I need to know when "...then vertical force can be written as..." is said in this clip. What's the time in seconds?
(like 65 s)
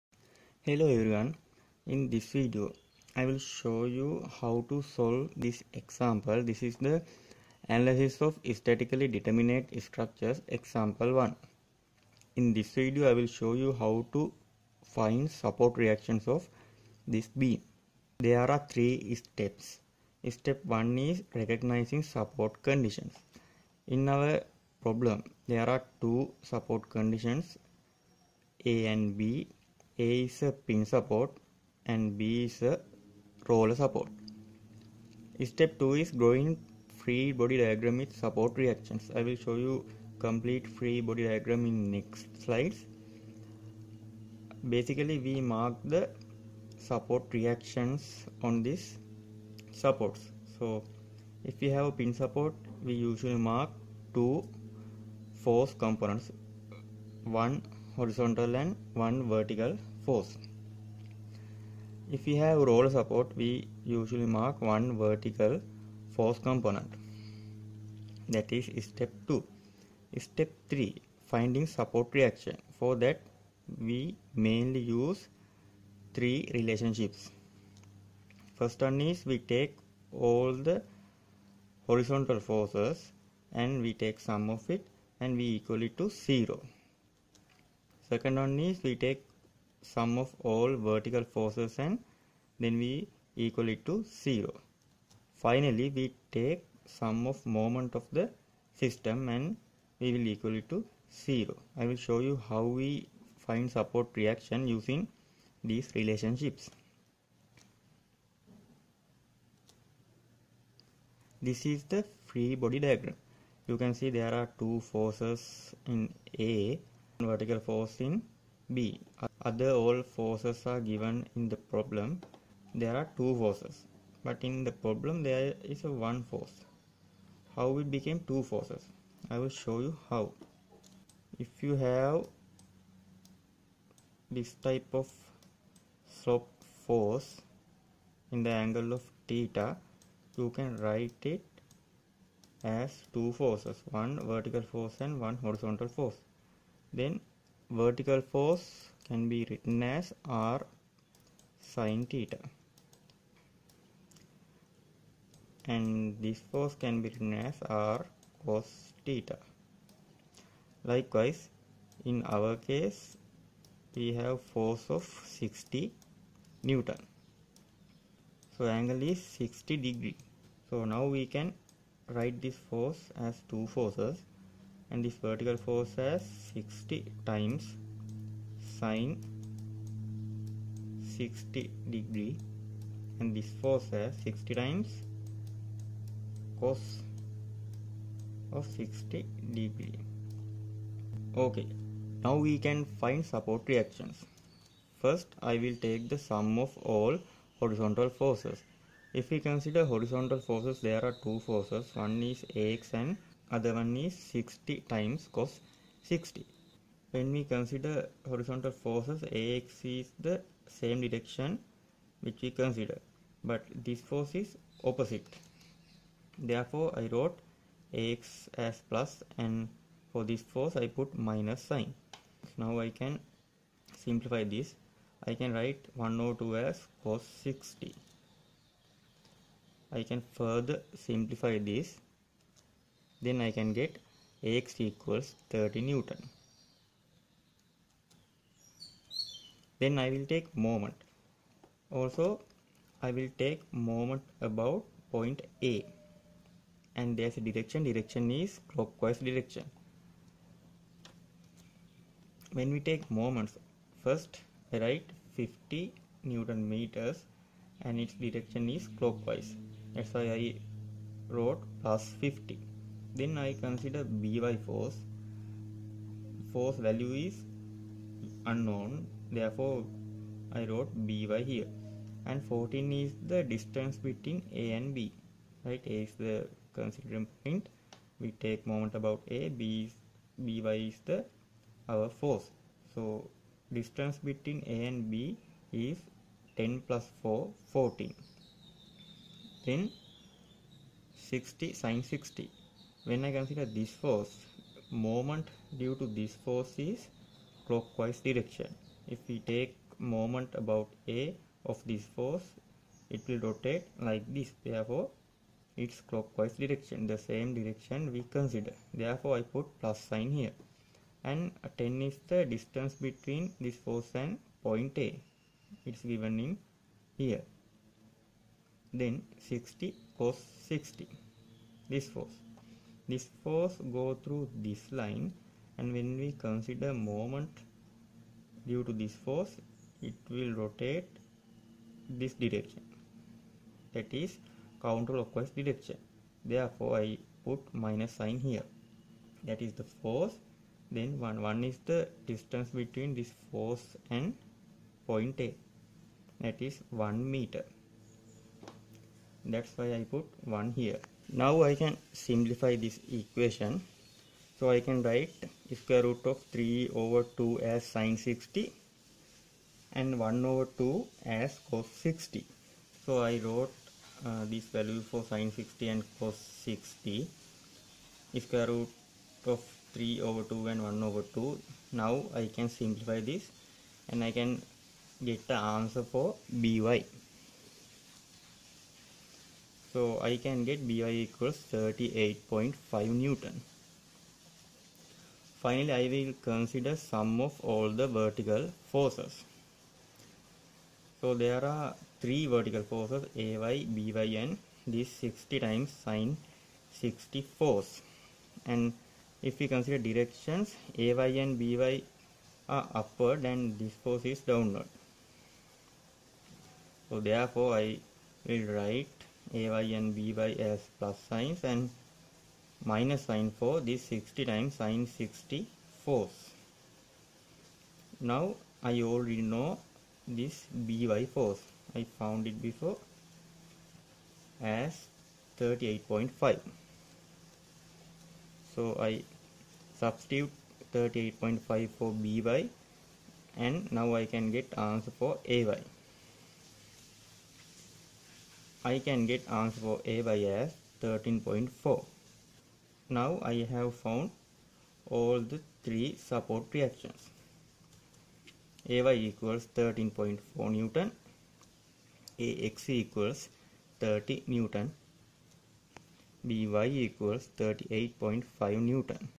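147 s.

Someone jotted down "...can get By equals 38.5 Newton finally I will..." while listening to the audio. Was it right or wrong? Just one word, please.
right.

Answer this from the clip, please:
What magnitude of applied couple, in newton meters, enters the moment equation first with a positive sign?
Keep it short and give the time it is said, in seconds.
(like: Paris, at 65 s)
50 Newton meters, at 255 s.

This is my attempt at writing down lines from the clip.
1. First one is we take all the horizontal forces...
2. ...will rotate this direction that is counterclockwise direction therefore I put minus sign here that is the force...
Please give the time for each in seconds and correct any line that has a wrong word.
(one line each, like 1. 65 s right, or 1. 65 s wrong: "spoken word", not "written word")
1. 78 s right
2. 330 s right.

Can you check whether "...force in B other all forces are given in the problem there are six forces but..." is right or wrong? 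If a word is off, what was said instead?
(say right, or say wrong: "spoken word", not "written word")
wrong: "two", not "six".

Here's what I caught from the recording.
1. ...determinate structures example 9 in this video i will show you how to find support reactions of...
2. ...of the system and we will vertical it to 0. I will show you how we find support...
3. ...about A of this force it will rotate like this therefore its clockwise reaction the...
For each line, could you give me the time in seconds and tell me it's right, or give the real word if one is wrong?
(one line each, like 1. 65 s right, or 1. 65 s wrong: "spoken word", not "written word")
1. 9 s wrong: "1", not "9"
2. 97 s wrong: "equal", not "vertical"
3. 300 s wrong: "direction", not "reaction".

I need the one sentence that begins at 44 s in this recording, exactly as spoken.
Basically we mark the support reactions on these supports.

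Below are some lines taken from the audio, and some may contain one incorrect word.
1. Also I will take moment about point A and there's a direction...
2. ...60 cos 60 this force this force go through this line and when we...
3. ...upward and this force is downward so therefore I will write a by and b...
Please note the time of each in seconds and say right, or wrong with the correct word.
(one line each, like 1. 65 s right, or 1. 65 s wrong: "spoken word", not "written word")
1. 241 s right
2. 319 s right
3. 402 s right.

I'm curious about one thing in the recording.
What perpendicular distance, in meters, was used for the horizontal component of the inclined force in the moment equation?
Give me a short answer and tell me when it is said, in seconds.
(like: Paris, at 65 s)
1 meter, at 347 s.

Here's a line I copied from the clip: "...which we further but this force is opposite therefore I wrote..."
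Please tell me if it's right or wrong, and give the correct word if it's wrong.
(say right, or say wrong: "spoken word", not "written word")
wrong: "consider", not "further".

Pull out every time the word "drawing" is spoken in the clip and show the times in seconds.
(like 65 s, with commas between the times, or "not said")
36 s.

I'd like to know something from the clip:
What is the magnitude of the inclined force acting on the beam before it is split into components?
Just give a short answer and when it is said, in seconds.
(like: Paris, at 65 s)
60 Newton, at 165 s.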